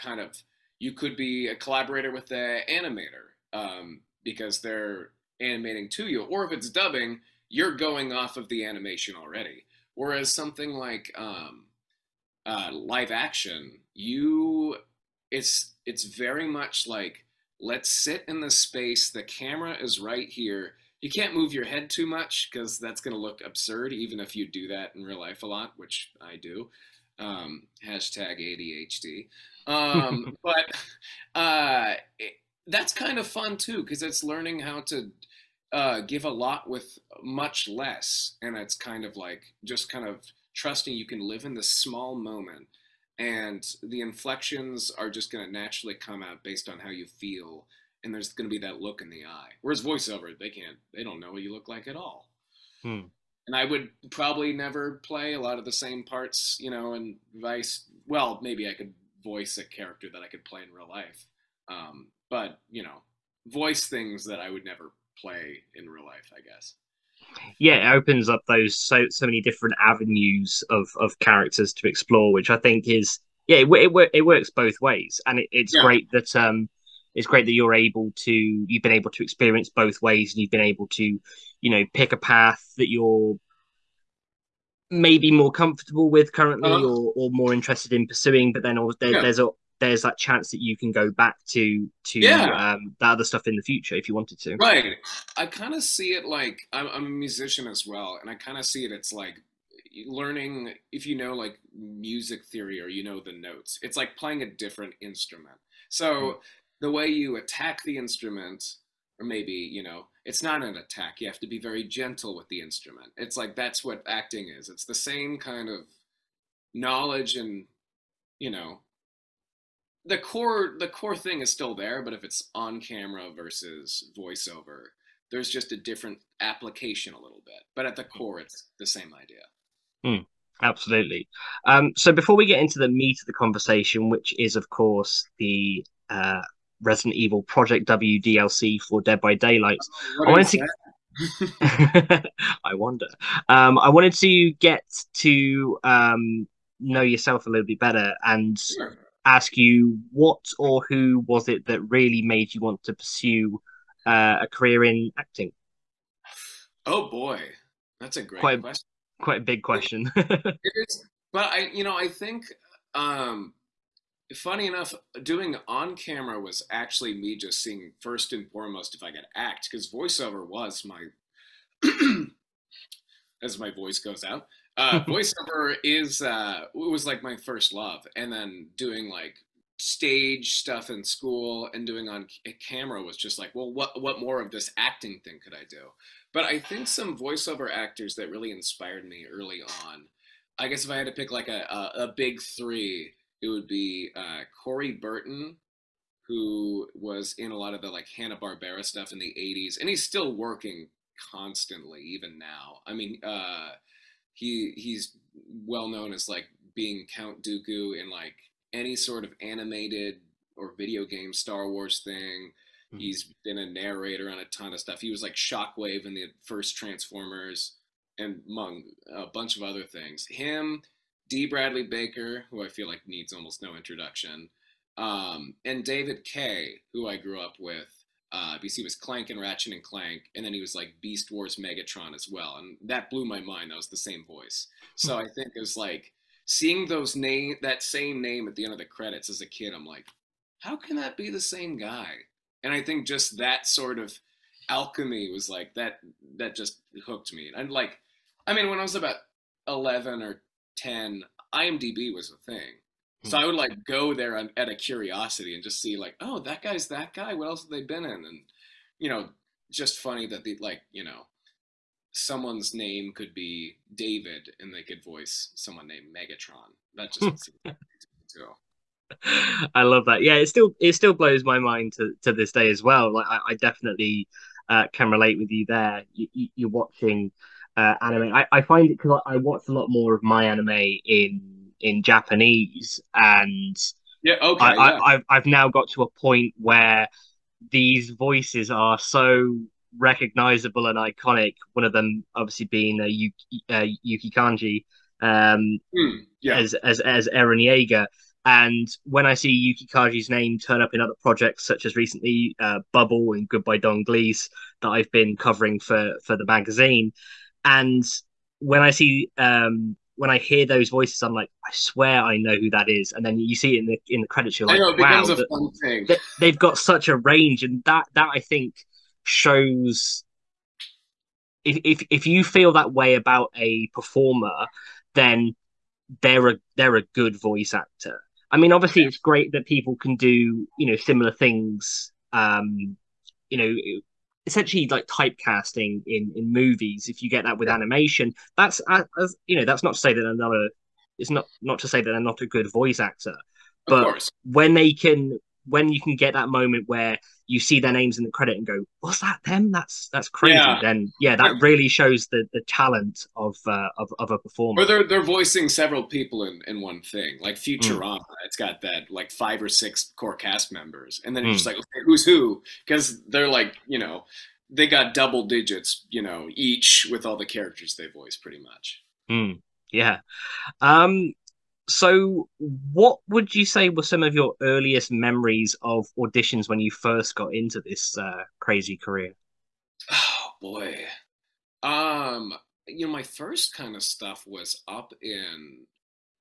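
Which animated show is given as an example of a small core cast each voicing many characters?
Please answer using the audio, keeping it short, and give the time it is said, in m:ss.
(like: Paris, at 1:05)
Futurama, at 5:57.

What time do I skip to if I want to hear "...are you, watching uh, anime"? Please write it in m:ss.
4:36.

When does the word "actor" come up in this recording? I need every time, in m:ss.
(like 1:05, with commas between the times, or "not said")
3:07, 5:27, 5:42.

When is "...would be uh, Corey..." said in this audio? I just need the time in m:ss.
3:13.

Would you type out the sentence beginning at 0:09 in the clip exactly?
Whereas something like um, uh, live action, you it's it's very much like let's sit in the space.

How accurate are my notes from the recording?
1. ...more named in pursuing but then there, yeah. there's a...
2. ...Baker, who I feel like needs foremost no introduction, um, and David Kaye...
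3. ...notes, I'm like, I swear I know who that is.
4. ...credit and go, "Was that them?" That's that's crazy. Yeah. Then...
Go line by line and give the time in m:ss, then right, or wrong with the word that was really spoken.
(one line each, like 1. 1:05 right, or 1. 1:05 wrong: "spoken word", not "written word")
1. 1:27 wrong: "interested", not "named"
2. 3:41 wrong: "almost", not "foremost"
3. 5:10 wrong: "voices", not "notes"
4. 5:48 right.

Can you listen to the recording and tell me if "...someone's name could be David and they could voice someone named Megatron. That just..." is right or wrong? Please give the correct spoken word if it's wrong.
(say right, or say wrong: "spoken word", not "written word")
right.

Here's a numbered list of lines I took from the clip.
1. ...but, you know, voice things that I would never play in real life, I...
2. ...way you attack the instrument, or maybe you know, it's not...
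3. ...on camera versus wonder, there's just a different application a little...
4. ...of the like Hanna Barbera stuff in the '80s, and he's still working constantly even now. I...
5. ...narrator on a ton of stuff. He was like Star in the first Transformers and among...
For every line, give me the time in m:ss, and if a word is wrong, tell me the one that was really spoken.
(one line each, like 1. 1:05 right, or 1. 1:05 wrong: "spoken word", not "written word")
1. 1:02 right
2. 1:46 right
3. 2:02 wrong: "voiceover", not "wonder"
4. 3:17 right
5. 3:33 wrong: "Shockwave", not "Star".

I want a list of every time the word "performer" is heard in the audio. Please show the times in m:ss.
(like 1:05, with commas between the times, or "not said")
5:23, 5:54.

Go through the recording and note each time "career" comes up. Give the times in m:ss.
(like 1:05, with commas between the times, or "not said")
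2:34, 6:18.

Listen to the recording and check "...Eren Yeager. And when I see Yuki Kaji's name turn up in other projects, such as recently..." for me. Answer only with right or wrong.
right.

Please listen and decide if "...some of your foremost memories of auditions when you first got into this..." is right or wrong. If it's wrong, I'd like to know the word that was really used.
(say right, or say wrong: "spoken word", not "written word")
wrong: "earliest", not "foremost".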